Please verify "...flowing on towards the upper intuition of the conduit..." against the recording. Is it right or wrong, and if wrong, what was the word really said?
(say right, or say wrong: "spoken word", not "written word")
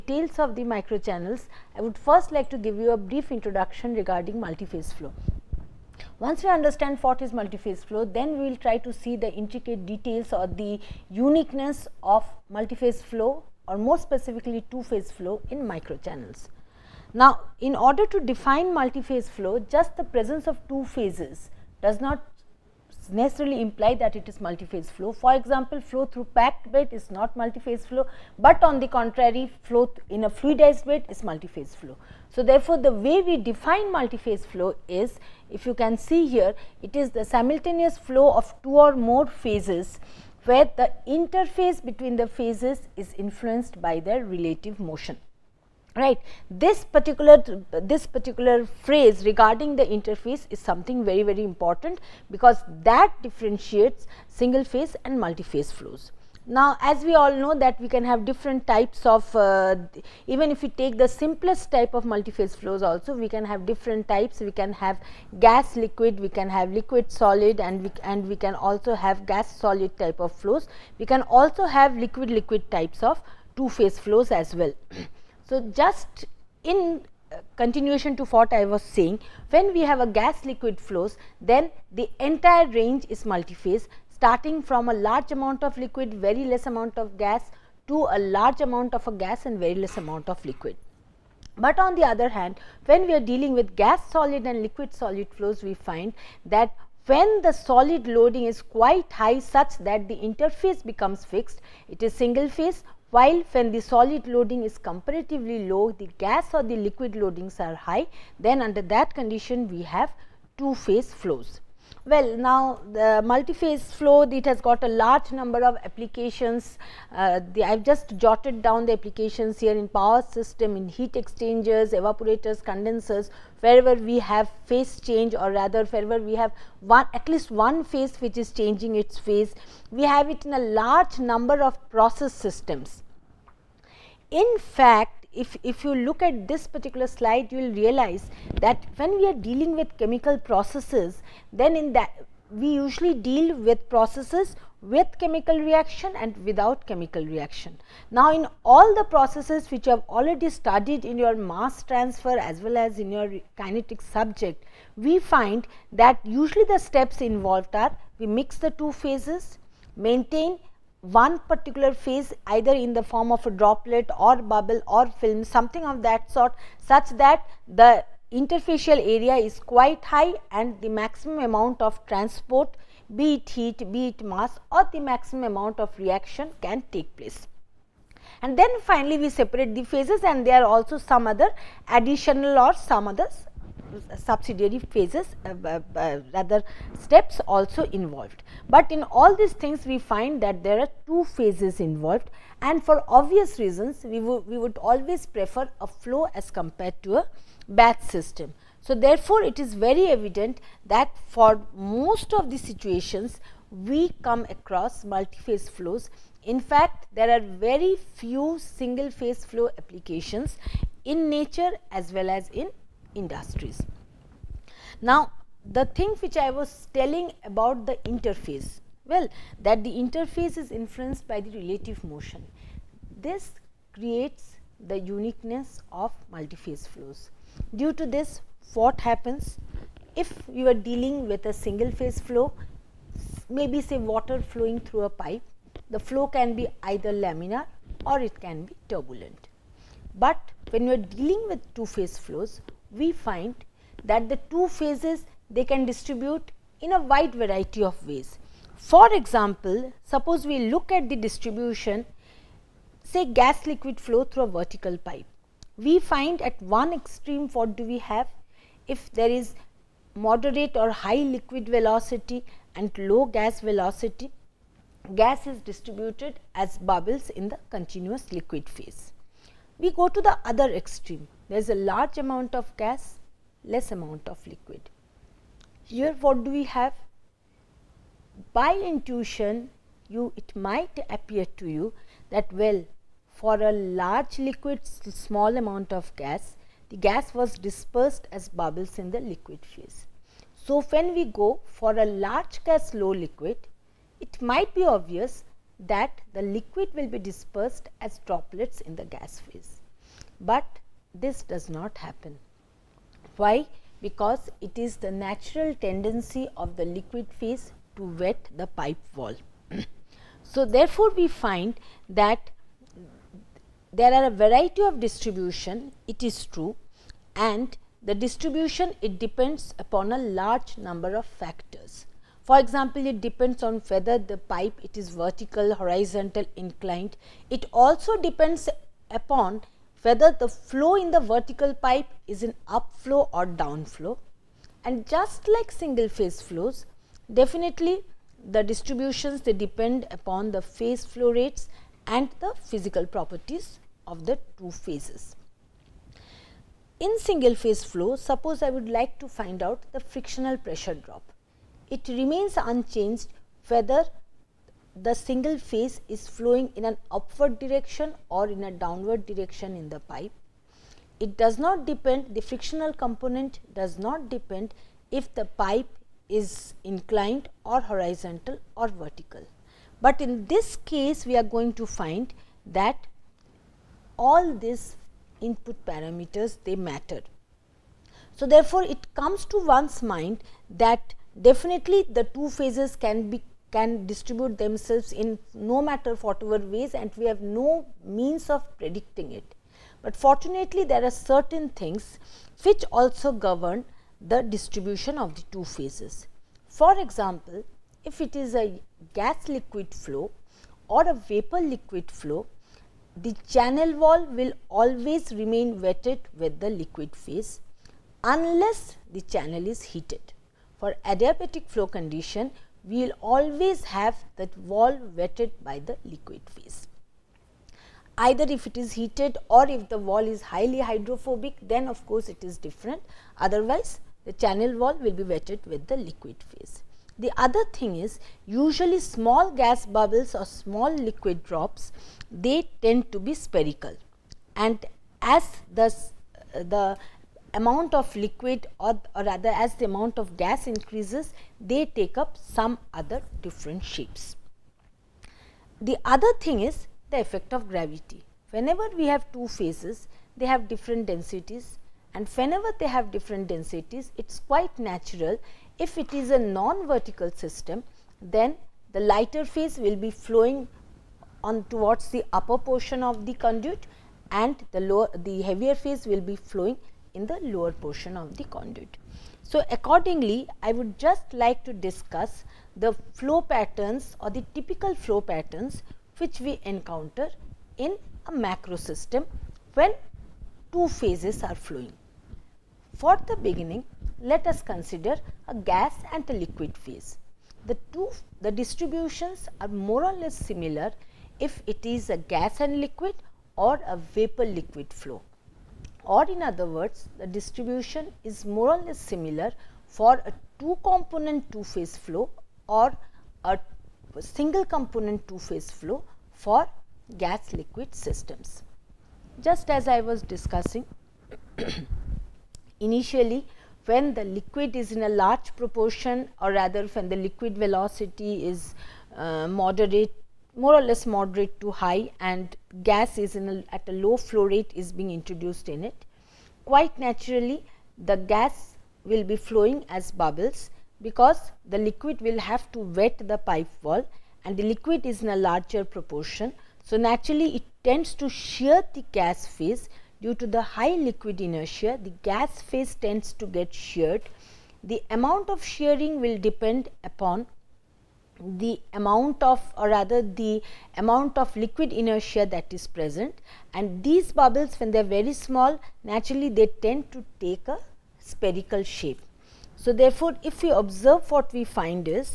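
wrong: "portion", not "intuition".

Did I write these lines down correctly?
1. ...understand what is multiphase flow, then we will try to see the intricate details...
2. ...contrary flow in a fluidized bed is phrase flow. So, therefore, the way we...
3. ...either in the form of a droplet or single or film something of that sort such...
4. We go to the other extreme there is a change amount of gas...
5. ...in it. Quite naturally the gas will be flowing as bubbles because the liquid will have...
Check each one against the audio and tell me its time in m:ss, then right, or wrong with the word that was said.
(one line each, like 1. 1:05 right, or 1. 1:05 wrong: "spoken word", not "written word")
1. 0:06 right
2. 0:28 wrong: "multiphase", not "phrase"
3. 2:42 wrong: "bubble", not "single"
4. 4:29 wrong: "large", not "change"
5. 8:45 right.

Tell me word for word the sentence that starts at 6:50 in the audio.
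For adiabatic flow condition, we will always have that wall wetted by the liquid phase.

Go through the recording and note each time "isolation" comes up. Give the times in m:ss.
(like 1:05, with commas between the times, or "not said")
not said.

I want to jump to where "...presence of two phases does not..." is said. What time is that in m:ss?
0:20.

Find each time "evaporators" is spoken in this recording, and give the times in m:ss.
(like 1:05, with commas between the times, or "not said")
2:01.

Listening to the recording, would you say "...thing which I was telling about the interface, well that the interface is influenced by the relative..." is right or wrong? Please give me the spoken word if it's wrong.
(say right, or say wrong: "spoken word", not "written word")
right.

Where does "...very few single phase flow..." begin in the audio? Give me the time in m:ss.
3:27.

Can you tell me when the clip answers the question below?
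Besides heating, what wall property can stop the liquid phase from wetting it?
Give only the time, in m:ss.
7:00.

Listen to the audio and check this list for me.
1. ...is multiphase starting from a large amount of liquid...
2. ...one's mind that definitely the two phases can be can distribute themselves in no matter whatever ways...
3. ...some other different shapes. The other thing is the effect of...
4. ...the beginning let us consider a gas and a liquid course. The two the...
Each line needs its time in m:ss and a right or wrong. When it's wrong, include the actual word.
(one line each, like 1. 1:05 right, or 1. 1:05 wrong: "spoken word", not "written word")
1. 1:23 right
2. 6:19 right
3. 7:22 right
4. 8:03 wrong: "phase", not "course".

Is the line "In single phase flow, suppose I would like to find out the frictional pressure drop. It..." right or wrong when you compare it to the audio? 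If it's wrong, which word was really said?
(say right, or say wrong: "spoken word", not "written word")
right.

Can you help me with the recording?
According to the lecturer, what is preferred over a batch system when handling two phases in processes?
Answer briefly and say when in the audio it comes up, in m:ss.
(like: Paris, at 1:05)
a flow, at 3:15.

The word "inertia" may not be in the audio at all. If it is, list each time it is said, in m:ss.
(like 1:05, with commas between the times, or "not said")
9:01, 9:11.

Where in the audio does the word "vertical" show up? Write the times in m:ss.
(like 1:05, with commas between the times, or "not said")
4:14, 5:25, 5:31, 6:08, 7:36.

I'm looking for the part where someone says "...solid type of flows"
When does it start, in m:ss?
1:09.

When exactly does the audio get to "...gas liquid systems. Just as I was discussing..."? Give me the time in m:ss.
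8:27.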